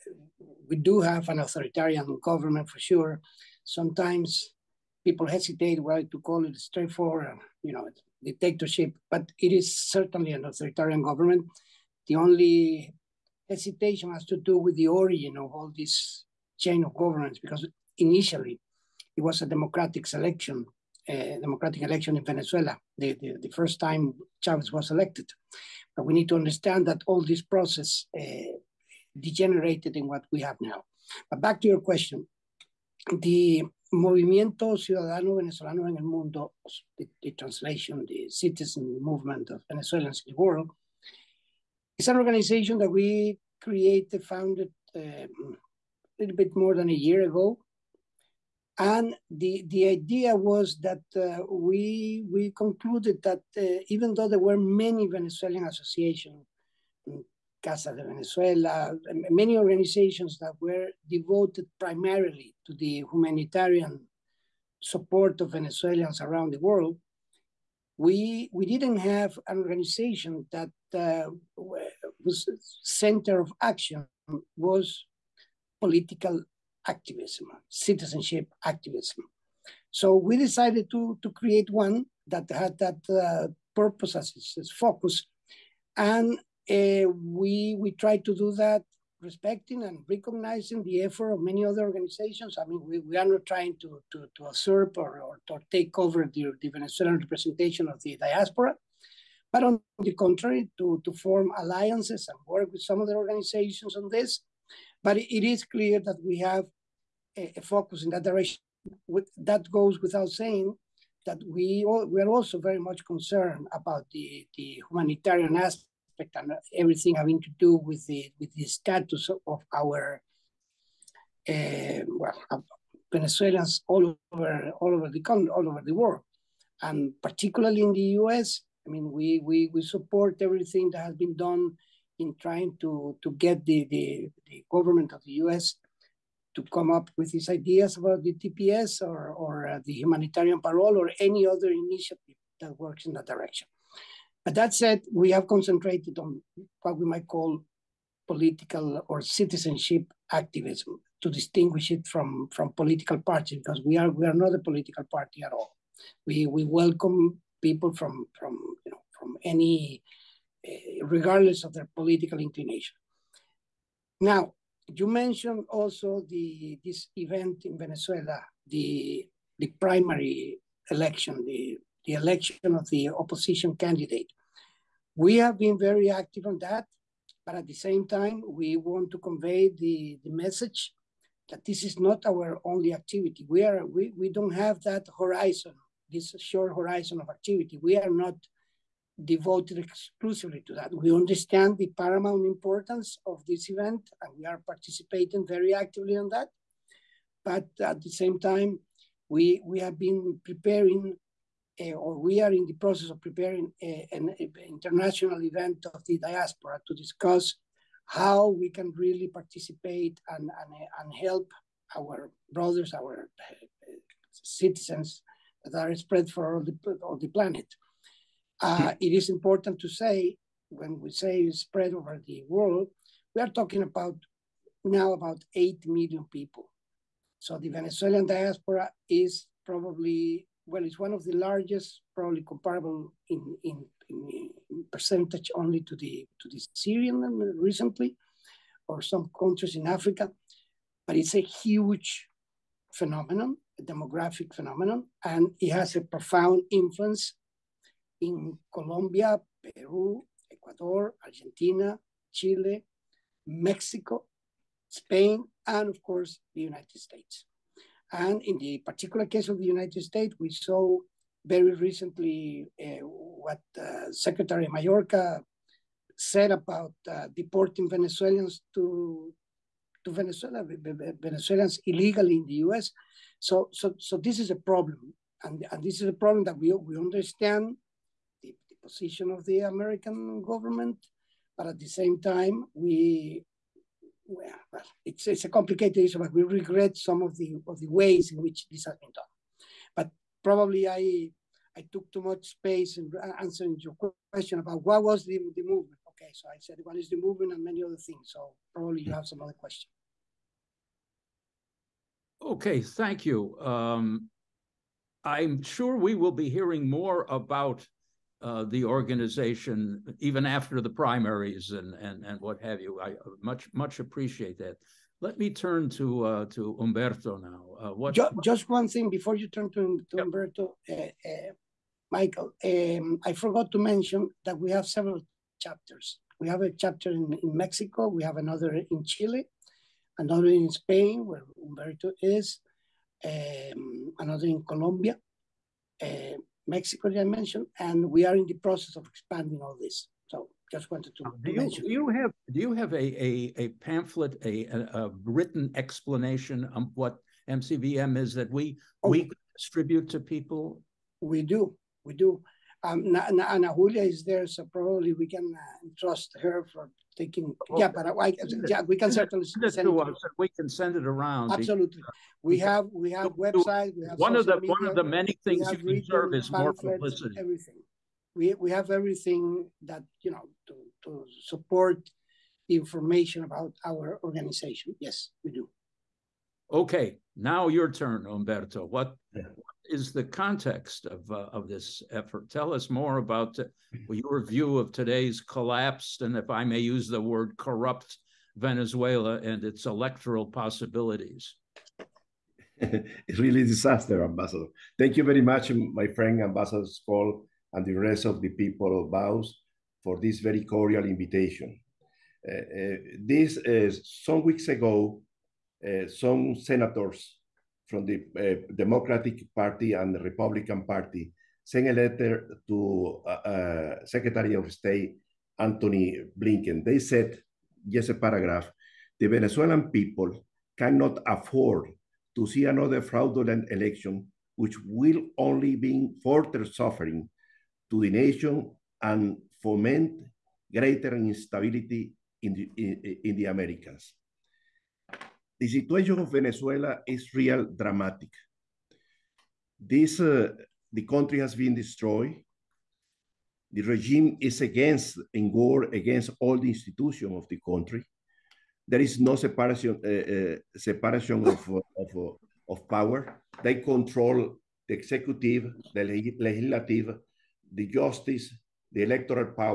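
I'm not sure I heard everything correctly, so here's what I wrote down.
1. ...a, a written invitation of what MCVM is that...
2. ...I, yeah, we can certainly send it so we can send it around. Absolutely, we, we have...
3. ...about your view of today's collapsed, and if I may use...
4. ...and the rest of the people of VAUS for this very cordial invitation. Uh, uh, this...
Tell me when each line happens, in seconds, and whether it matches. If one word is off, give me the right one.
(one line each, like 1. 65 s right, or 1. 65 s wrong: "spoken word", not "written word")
1. 344 s wrong: "explanation", not "invitation"
2. 358 s right
3. 383 s right
4. 397 s right.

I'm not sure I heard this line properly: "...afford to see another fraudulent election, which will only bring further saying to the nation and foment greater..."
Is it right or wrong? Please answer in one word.
wrong.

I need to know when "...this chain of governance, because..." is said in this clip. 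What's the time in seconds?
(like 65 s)
15 s.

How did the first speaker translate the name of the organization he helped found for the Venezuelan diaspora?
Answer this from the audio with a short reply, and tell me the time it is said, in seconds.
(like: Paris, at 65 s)
Citizen movement of Venezuelans in the world, at 38 s.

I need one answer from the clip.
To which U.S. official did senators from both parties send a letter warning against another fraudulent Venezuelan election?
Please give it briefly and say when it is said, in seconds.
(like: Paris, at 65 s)
Antony Blinken, at 415 s.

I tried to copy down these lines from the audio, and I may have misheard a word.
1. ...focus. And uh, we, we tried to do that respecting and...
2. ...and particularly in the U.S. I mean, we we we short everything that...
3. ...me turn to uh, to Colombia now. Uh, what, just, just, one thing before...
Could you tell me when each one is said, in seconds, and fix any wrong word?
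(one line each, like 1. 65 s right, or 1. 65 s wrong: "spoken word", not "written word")
1. 84 s right
2. 126 s wrong: "support", not "short"
3. 315 s wrong: "Humberto", not "Colombia".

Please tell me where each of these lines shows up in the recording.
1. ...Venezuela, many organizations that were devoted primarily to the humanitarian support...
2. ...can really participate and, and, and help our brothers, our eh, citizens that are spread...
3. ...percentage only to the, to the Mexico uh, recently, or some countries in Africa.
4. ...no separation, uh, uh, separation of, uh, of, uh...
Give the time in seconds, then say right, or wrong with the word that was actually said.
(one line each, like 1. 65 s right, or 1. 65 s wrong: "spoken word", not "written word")
1. 58 s right
2. 208 s right
3. 234 s wrong: "Syrian", not "Mexico"
4. 449 s right.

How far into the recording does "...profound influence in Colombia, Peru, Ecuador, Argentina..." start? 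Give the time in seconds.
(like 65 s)
246 s.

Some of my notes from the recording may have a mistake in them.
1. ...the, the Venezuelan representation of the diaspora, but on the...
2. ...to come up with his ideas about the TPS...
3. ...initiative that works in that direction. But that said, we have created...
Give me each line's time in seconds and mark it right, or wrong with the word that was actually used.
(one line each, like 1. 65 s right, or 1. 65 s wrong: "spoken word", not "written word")
1. 96 s right
2. 136 s right
3. 141 s wrong: "concentrated", not "created".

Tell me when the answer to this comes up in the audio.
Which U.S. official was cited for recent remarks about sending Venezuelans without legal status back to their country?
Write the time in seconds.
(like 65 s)
264 s.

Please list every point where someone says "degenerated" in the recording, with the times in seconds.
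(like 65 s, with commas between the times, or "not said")
29 s.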